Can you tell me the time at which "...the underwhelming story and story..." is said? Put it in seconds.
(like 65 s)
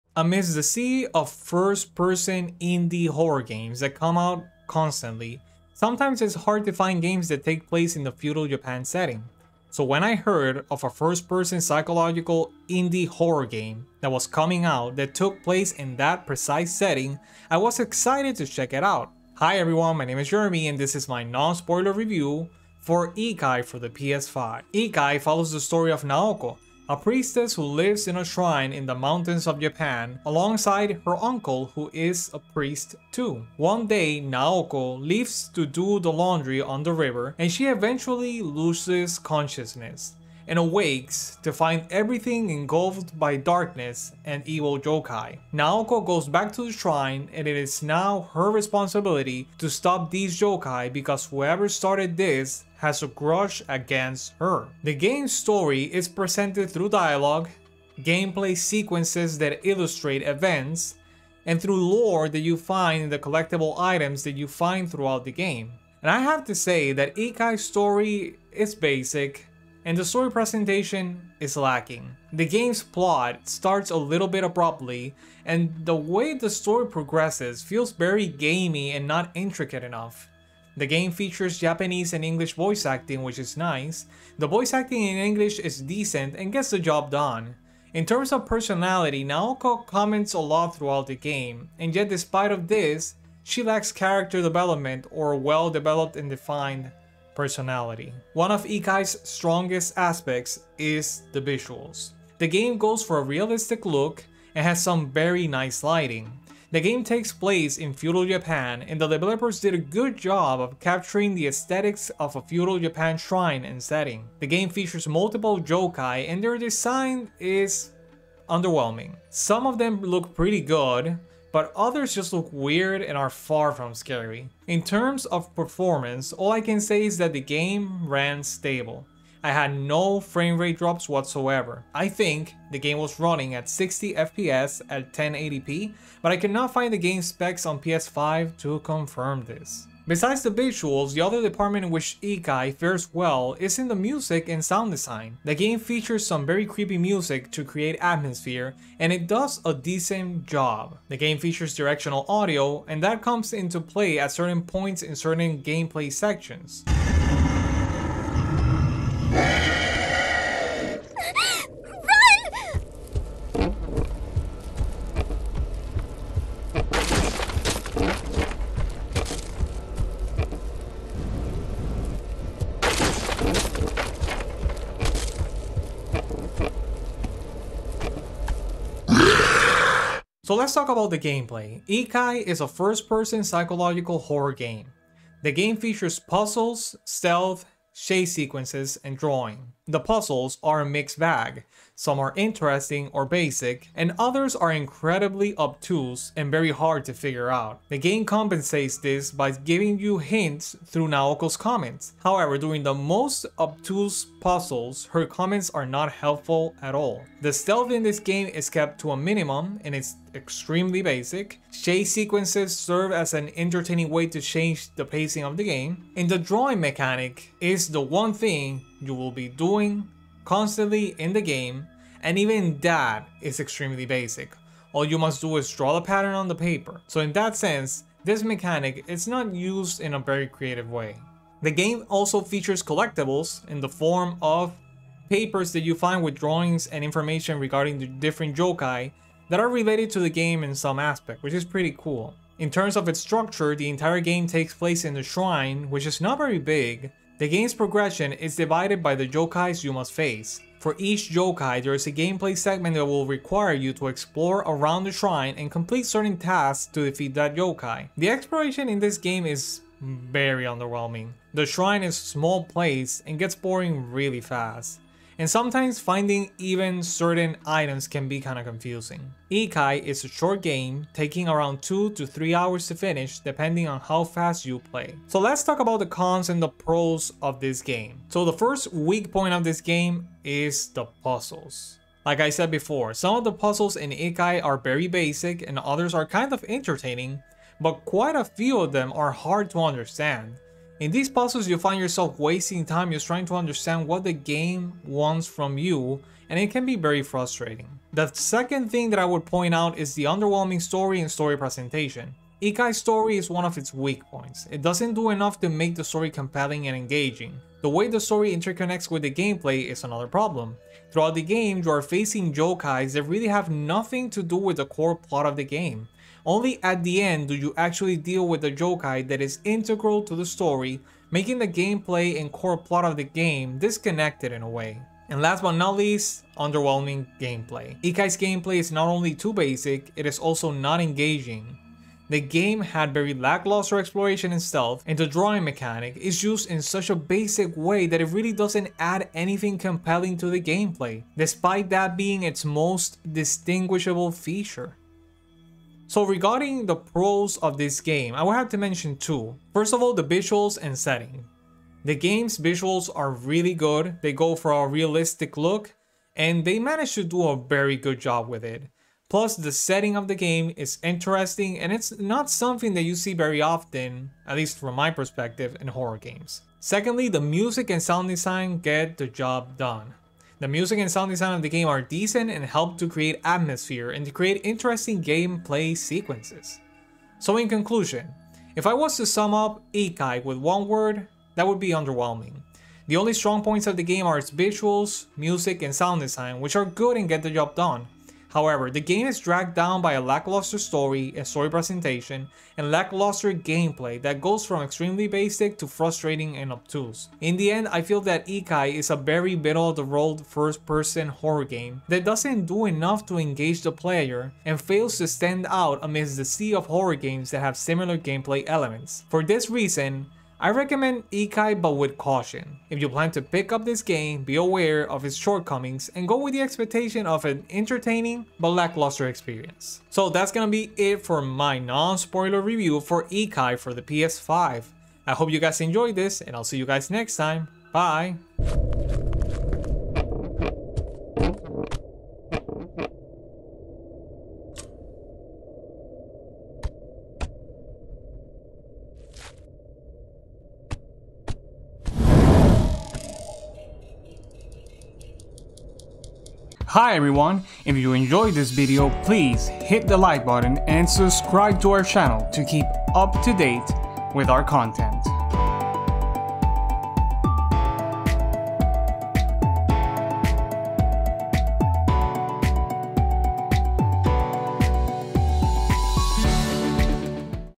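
300 s.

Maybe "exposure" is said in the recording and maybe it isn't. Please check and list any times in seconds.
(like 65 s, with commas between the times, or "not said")
not said.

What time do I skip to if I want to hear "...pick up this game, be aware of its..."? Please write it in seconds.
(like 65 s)
413 s.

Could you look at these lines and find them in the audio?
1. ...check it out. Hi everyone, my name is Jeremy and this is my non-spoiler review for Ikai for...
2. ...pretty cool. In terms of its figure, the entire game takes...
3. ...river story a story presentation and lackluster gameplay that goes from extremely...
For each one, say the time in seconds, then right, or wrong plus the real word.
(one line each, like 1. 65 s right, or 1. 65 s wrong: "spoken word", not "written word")
1. 18 s right
2. 241 s wrong: "structure", not "figure"
3. 390 s wrong: "lackluster", not "river".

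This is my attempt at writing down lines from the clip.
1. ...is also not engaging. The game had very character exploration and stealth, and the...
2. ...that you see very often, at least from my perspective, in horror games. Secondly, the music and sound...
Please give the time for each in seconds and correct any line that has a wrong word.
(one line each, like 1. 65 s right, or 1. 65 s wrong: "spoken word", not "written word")
1. 330 s wrong: "lackluster", not "character"
2. 362 s right.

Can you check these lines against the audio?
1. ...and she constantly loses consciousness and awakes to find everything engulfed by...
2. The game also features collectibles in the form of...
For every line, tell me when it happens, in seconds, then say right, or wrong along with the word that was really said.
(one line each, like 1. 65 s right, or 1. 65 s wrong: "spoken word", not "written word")
1. 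37 s wrong: "eventually", not "constantly"
2. 231 s right.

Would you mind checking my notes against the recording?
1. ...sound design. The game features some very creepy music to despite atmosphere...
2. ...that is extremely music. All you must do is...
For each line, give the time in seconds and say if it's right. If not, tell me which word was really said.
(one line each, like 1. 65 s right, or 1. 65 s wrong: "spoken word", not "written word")
1. 144 s wrong: "create", not "despite"
2. 222 s wrong: "basic", not "music".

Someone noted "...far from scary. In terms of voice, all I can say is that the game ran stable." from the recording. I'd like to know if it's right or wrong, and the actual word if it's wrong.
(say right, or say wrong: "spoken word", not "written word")
wrong: "performance", not "voice".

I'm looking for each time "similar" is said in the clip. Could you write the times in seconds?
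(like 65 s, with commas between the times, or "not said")
407 s.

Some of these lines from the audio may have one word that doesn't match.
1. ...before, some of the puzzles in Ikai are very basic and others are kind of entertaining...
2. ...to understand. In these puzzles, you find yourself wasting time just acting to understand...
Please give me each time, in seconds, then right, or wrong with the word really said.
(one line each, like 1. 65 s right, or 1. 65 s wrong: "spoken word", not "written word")
1. 282 s right
2. 289 s wrong: "trying", not "acting".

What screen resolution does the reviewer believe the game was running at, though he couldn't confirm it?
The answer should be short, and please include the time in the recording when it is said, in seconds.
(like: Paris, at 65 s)
1080p, at 135 s.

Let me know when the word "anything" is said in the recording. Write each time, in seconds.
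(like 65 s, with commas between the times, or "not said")
339 s.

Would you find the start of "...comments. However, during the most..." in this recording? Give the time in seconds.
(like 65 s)
201 s.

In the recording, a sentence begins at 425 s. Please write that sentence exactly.
I hope you guys enjoyed this and I'll see you guys next time.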